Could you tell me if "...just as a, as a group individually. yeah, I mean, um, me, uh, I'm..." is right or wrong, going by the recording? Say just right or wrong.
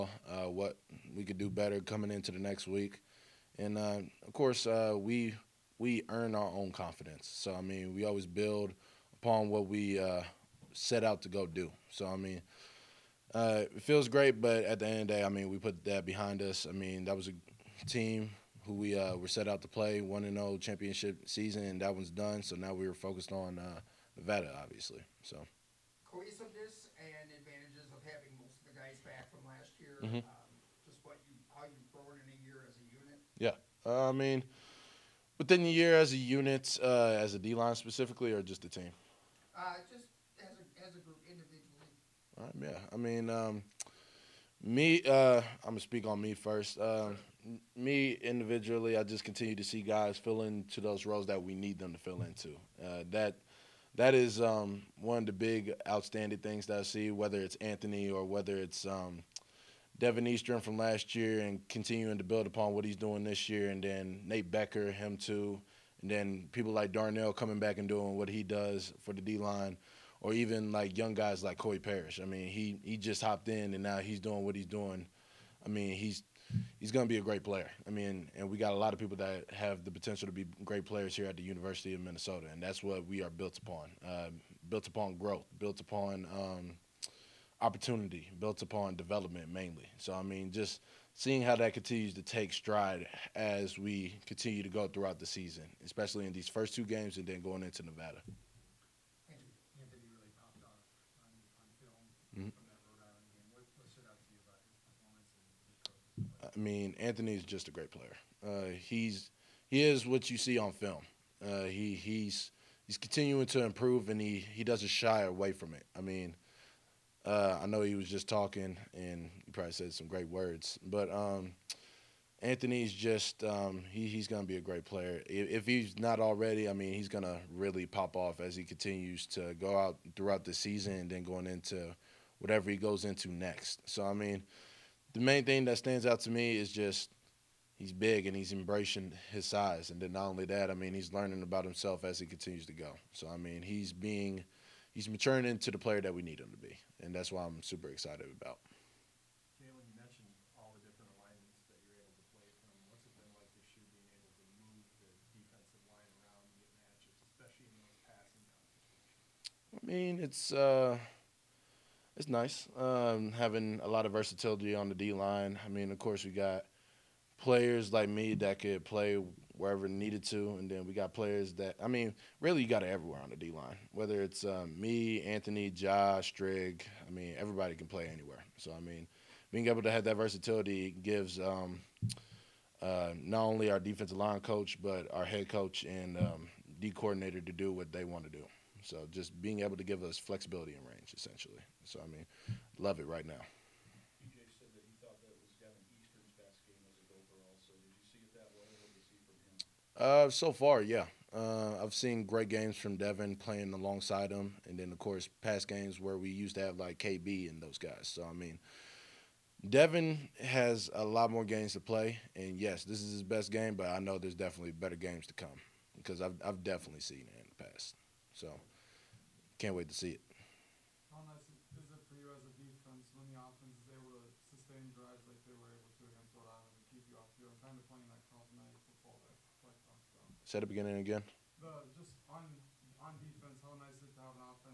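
right.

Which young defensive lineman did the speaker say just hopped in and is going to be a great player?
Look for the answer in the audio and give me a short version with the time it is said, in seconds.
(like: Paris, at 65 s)
Corey Parrish, at 71 s.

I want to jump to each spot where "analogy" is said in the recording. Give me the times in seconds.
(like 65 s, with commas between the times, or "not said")
not said.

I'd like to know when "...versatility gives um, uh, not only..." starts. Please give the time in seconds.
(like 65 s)
180 s.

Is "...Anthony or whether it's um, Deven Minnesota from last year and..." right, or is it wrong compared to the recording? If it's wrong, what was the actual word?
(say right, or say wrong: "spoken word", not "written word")
wrong: "Eastern", not "Minnesota".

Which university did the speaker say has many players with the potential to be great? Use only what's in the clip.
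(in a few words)
University of Minnesota.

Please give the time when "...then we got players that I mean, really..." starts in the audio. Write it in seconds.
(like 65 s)
170 s.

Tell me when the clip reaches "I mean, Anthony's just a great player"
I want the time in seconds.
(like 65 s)
106 s.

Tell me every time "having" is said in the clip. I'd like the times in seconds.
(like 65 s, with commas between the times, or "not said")
28 s, 163 s.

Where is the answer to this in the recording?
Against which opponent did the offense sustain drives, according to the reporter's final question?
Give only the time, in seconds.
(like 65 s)
226 s.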